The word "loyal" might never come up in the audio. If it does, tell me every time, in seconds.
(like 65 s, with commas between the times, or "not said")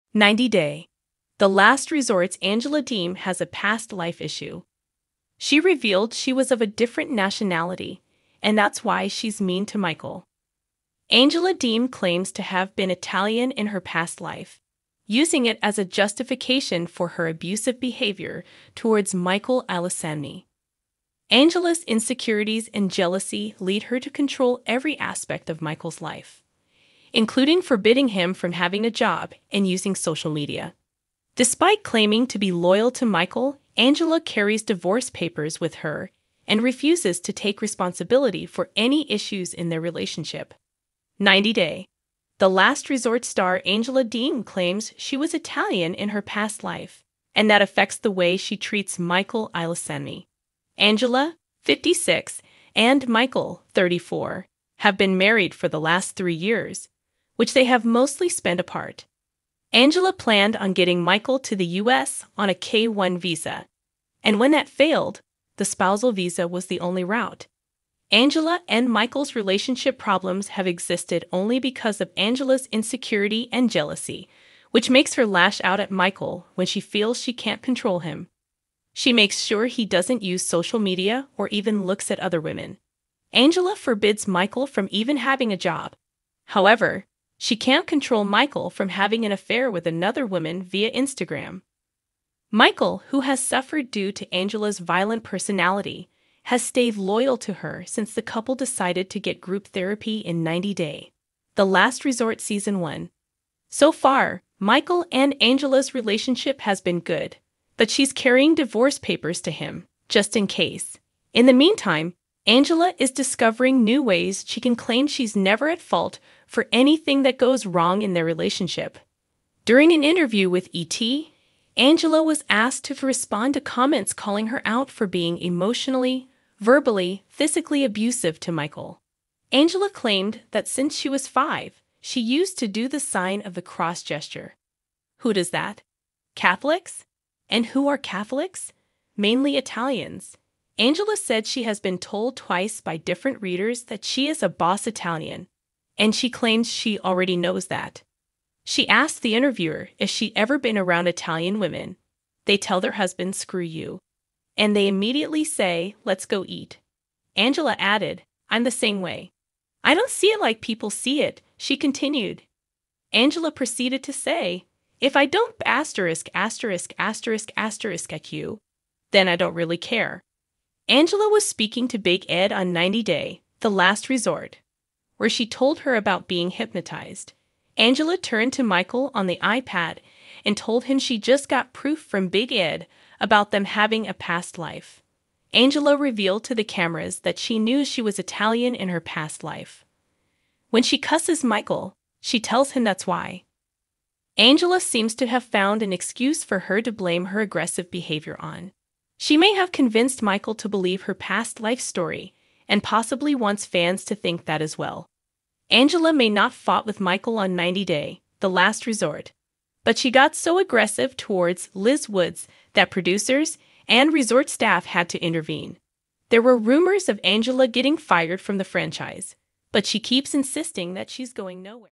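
32 s, 96 s.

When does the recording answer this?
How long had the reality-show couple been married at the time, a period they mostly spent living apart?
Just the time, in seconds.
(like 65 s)
56 s.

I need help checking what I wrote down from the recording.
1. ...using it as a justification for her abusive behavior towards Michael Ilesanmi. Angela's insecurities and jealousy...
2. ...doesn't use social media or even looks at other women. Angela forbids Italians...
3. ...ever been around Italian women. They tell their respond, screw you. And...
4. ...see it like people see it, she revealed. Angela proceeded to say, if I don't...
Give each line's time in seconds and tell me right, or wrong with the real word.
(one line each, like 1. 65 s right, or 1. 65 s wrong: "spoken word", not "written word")
1. 15 s right
2. 79 s wrong: "Michael", not "Italians"
3. 150 s wrong: "husband", not "respond"
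4. 160 s wrong: "continued", not "revealed".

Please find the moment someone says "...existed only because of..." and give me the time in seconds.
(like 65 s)
70 s.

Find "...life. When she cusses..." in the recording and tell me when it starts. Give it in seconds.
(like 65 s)
189 s.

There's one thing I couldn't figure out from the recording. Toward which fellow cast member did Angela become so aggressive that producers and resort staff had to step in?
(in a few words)
Liz Woods.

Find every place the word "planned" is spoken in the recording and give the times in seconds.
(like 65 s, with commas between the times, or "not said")
60 s.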